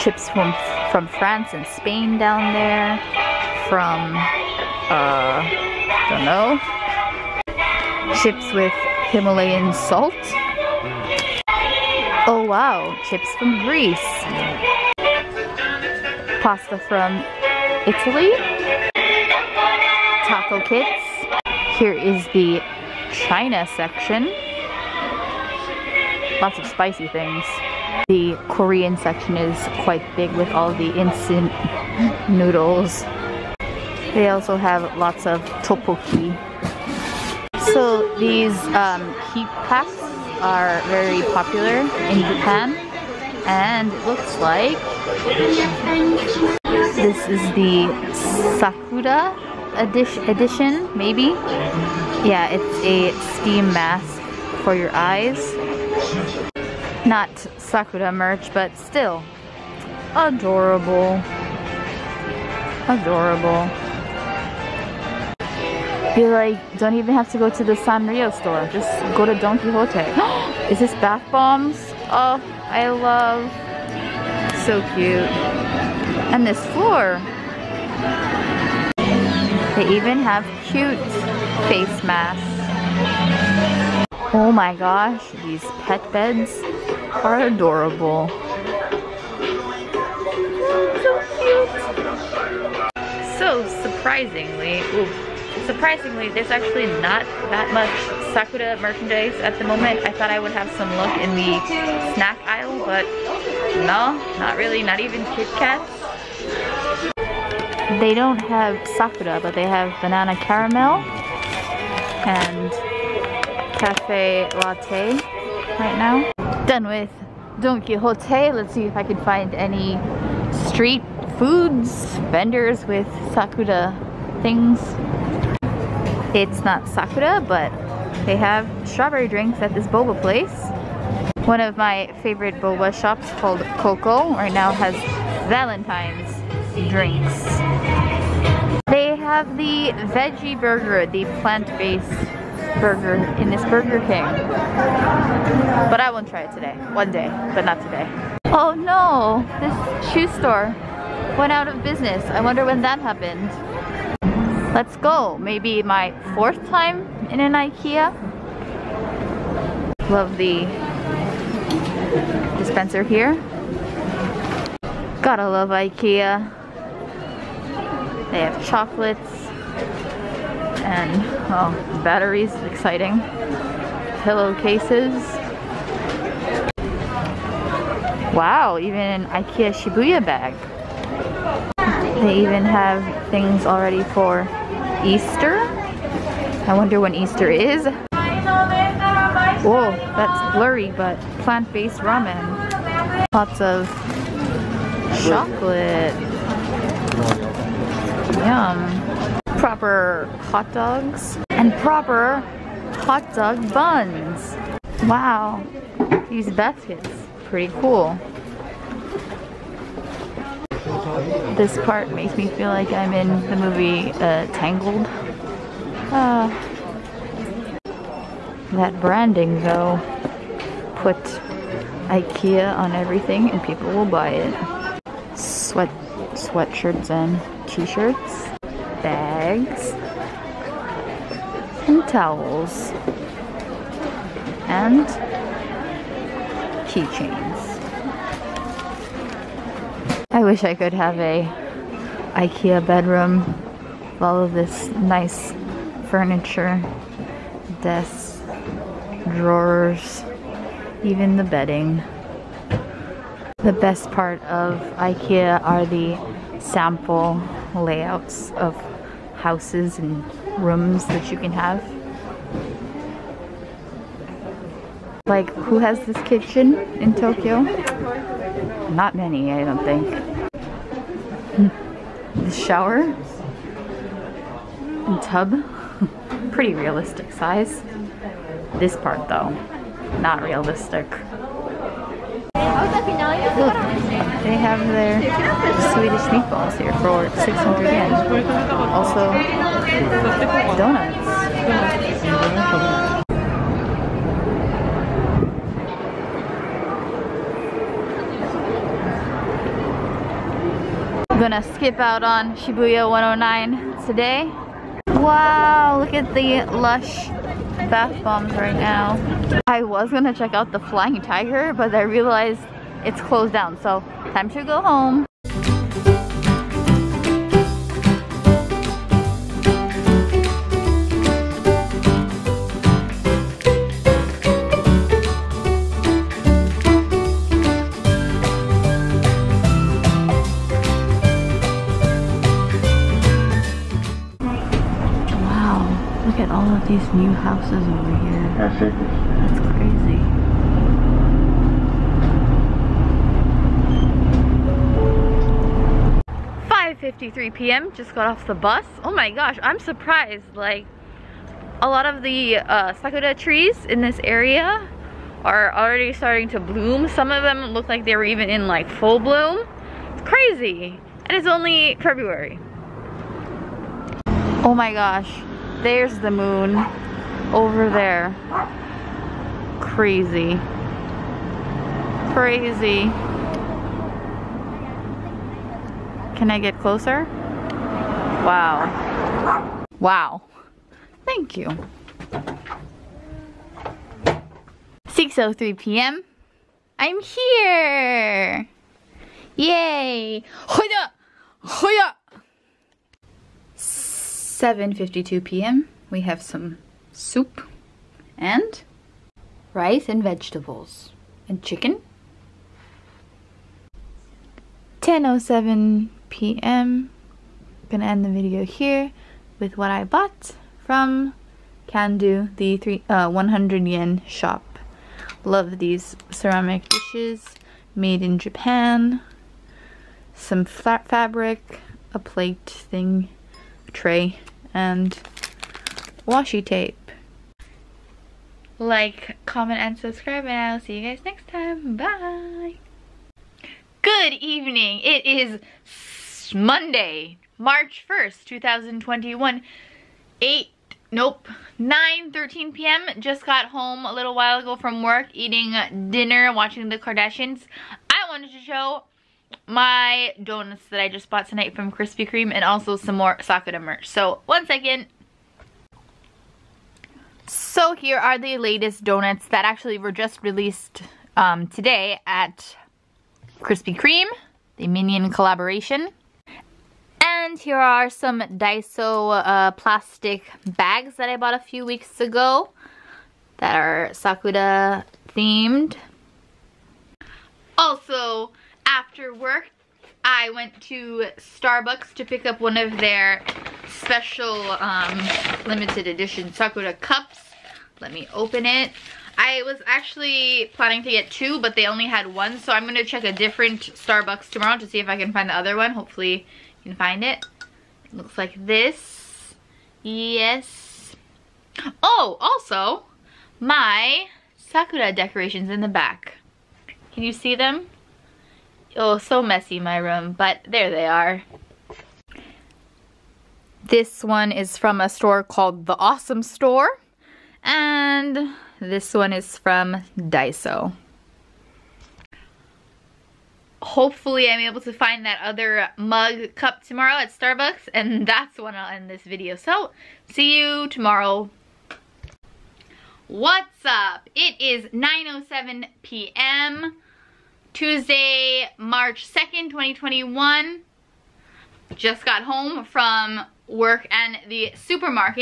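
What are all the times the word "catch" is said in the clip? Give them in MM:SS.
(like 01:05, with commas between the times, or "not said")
not said.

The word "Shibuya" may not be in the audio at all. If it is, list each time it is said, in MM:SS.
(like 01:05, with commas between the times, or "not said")
02:59, 05:02.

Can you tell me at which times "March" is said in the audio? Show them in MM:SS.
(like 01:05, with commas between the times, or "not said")
07:17, 08:58.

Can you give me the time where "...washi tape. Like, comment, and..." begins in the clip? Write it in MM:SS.
07:06.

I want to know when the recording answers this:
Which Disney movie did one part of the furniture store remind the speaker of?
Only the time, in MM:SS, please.
03:34.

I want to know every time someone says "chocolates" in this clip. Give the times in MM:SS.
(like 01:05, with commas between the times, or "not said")
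02:48, 03:15.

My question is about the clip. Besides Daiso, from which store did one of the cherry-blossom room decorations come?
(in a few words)
The Awesome Store.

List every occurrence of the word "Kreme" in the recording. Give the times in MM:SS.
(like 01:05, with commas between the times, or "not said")
07:32, 07:43.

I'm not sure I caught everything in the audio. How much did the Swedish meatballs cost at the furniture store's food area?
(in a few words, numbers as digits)
600 yen.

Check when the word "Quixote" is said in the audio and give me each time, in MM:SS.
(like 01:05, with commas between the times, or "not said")
01:09, 01:57.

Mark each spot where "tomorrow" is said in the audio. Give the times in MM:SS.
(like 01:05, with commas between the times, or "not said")
08:14, 08:46, 08:50.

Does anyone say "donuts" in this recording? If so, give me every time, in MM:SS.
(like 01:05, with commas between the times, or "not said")
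04:50, 07:30, 07:39.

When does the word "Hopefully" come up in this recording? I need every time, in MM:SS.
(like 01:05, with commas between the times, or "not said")
08:15, 08:43.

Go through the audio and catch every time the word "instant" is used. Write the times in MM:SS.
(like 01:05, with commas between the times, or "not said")
00:30.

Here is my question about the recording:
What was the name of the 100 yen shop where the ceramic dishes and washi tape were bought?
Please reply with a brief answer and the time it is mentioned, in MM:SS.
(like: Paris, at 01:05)
Kandu, at 06:51.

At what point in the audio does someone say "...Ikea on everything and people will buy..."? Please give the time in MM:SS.
03:42.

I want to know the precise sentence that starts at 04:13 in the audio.
The best part of Ikea are the sample layouts of houses and rooms that you can have.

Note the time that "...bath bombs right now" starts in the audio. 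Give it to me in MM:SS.
05:07.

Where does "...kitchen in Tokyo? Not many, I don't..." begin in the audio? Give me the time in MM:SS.
04:26.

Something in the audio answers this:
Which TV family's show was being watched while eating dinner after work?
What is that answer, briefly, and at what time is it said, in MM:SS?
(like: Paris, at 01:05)
The Kardashians, at 07:26.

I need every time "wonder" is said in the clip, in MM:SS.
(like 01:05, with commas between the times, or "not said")
02:32, 03:06.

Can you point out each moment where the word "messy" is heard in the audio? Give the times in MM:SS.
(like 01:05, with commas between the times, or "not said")
08:29.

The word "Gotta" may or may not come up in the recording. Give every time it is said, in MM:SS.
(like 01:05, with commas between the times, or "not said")
02:45.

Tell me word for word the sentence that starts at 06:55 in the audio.
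Love these ceramic dishes made in Japan.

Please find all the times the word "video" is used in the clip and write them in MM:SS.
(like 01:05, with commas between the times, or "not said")
06:48, 08:49.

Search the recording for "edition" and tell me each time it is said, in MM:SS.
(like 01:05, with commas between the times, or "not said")
00:49, 08:06.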